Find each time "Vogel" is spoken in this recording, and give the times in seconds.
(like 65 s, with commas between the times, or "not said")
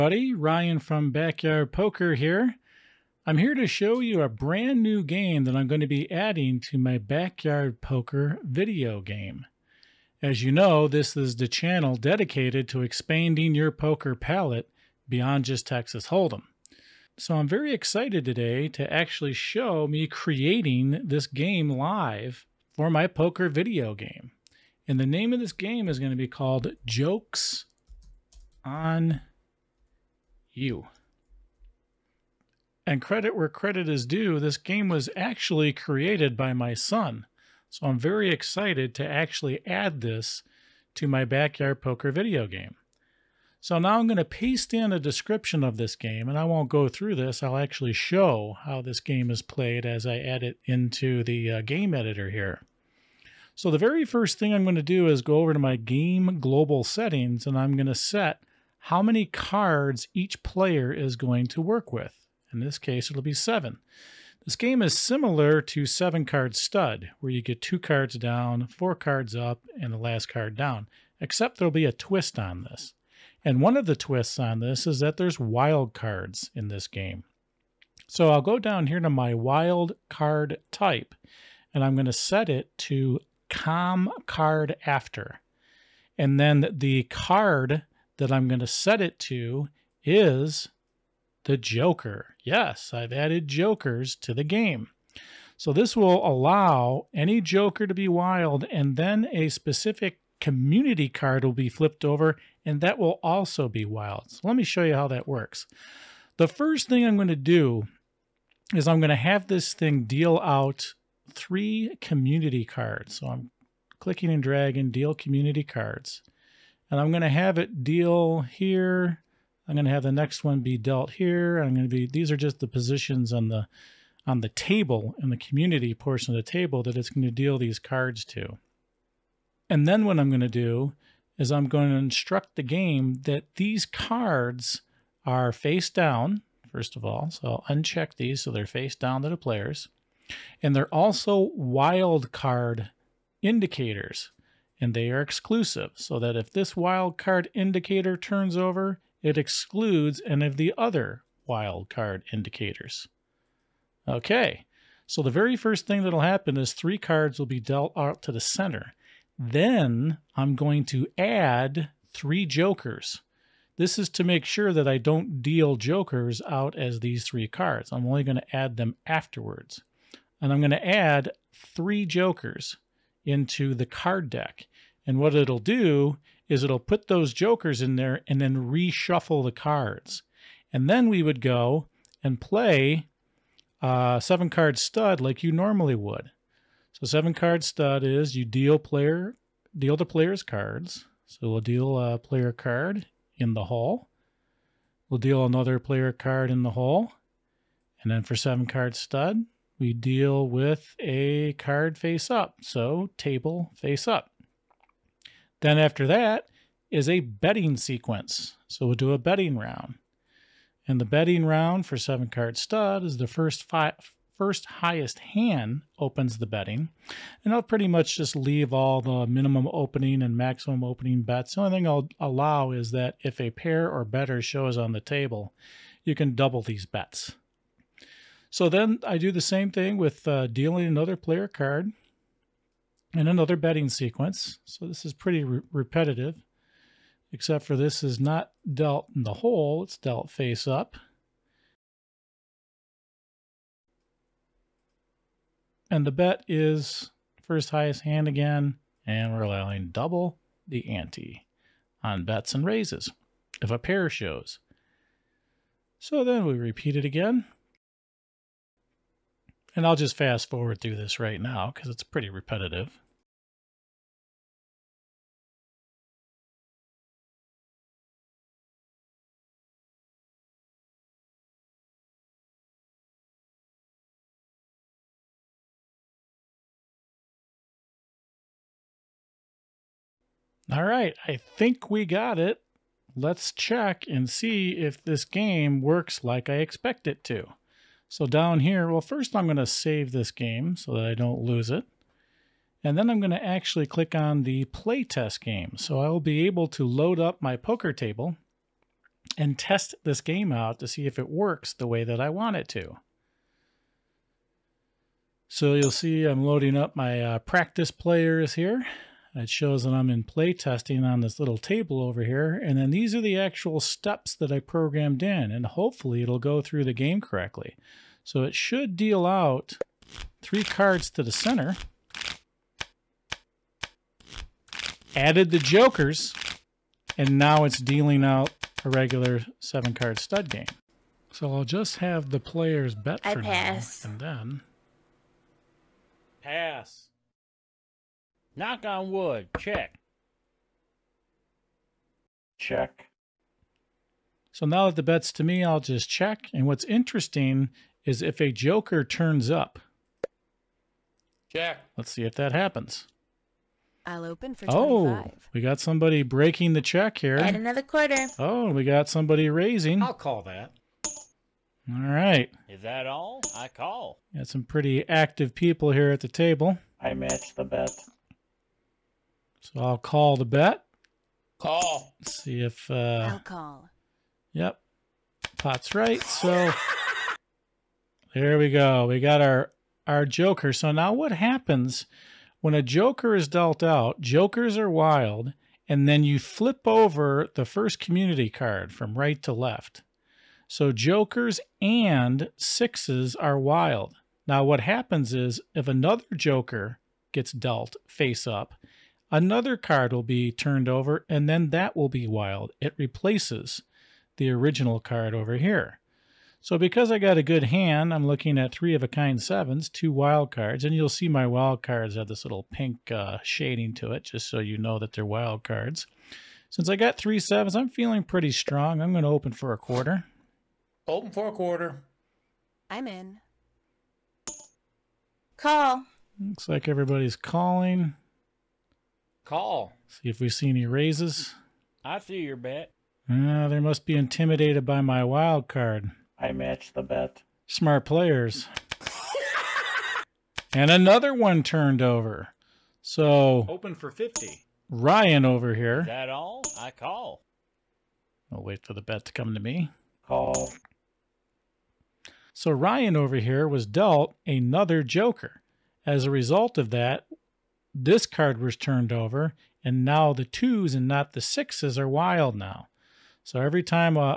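not said.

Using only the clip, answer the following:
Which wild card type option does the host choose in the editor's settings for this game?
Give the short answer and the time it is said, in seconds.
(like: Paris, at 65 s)
com card after, at 83 s.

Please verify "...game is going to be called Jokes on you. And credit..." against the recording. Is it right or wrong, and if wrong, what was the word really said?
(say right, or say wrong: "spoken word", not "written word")
right.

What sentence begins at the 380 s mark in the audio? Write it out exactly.
So now what happens when a joker is dealt out?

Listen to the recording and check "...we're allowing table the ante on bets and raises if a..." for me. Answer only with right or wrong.
wrong.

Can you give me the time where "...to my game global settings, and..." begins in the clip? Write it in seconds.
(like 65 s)
55 s.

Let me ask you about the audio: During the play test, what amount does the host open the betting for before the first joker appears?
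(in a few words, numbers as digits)
25.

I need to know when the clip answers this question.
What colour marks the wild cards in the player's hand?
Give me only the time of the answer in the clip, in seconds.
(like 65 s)
412 s.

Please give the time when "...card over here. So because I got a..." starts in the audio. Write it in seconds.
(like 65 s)
404 s.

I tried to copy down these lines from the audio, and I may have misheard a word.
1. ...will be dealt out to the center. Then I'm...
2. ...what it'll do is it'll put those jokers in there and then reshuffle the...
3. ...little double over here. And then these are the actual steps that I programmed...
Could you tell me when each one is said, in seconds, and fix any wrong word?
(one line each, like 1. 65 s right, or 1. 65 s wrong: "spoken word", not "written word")
1. 157 s right
2. 175 s right
3. 311 s wrong: "table", not "double".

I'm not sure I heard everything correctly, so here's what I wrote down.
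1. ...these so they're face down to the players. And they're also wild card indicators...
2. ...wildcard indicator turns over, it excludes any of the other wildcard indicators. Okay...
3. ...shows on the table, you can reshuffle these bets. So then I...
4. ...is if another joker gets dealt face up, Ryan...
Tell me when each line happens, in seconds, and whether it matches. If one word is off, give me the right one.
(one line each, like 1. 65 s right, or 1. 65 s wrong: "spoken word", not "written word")
1. 138 s right
2. 146 s right
3. 224 s wrong: "double", not "reshuffle"
4. 395 s wrong: "Another", not "Ryan".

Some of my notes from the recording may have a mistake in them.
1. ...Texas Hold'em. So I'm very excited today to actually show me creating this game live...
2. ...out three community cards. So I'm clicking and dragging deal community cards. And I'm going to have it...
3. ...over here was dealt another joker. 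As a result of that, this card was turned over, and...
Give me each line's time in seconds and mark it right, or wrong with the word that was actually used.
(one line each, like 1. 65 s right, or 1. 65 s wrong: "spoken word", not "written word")
1. 15 s right
2. 110 s right
3. 453 s right.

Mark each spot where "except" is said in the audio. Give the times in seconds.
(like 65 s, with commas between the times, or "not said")
71 s, 237 s.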